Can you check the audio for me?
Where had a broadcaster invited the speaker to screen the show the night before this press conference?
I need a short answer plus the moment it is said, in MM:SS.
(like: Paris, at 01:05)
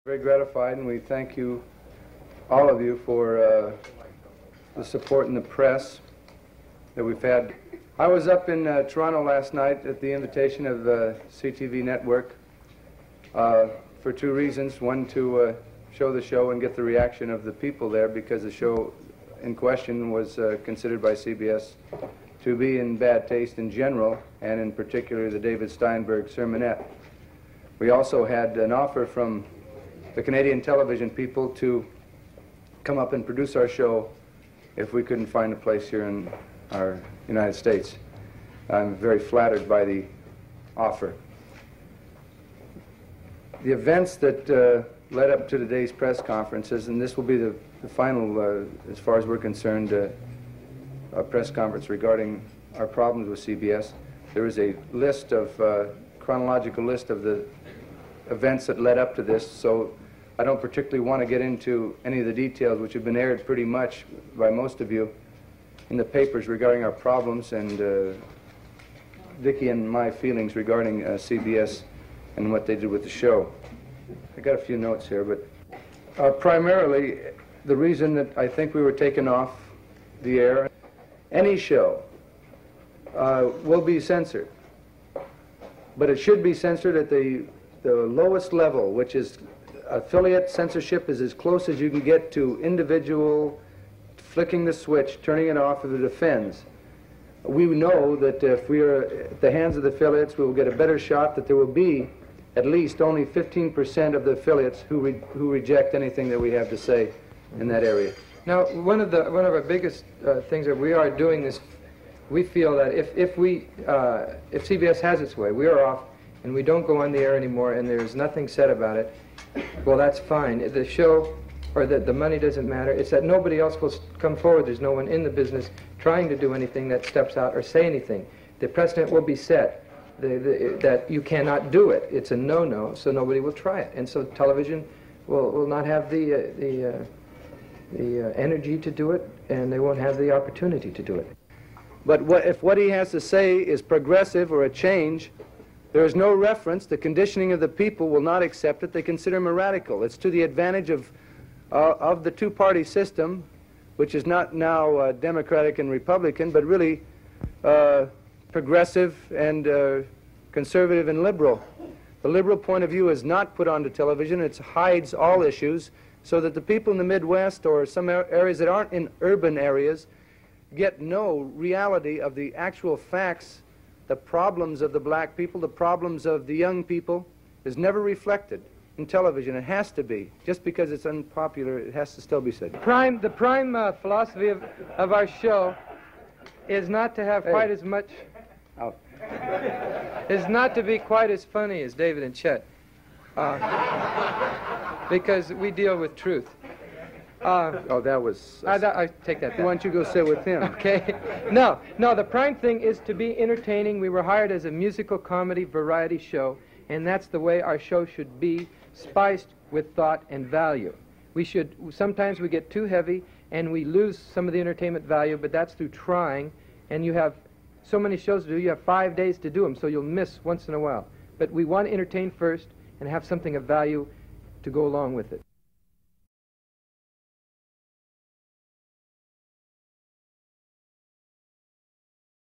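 Toronto, at 00:08.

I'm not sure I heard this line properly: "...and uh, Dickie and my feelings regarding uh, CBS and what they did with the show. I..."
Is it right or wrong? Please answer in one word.
right.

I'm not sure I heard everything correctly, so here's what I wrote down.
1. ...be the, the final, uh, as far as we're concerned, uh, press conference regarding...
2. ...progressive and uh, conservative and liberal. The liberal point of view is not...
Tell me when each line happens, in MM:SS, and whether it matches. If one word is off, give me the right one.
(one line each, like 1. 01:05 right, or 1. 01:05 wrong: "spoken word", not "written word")
1. 00:47 right
2. 02:38 right.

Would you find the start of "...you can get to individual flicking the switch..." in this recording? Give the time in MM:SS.
01:31.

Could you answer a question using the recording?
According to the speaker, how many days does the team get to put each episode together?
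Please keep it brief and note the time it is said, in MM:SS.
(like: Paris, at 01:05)
5, at 03:38.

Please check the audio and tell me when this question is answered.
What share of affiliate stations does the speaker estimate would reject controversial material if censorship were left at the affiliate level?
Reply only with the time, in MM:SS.
01:43.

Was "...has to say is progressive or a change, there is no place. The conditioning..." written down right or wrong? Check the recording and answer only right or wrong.
wrong.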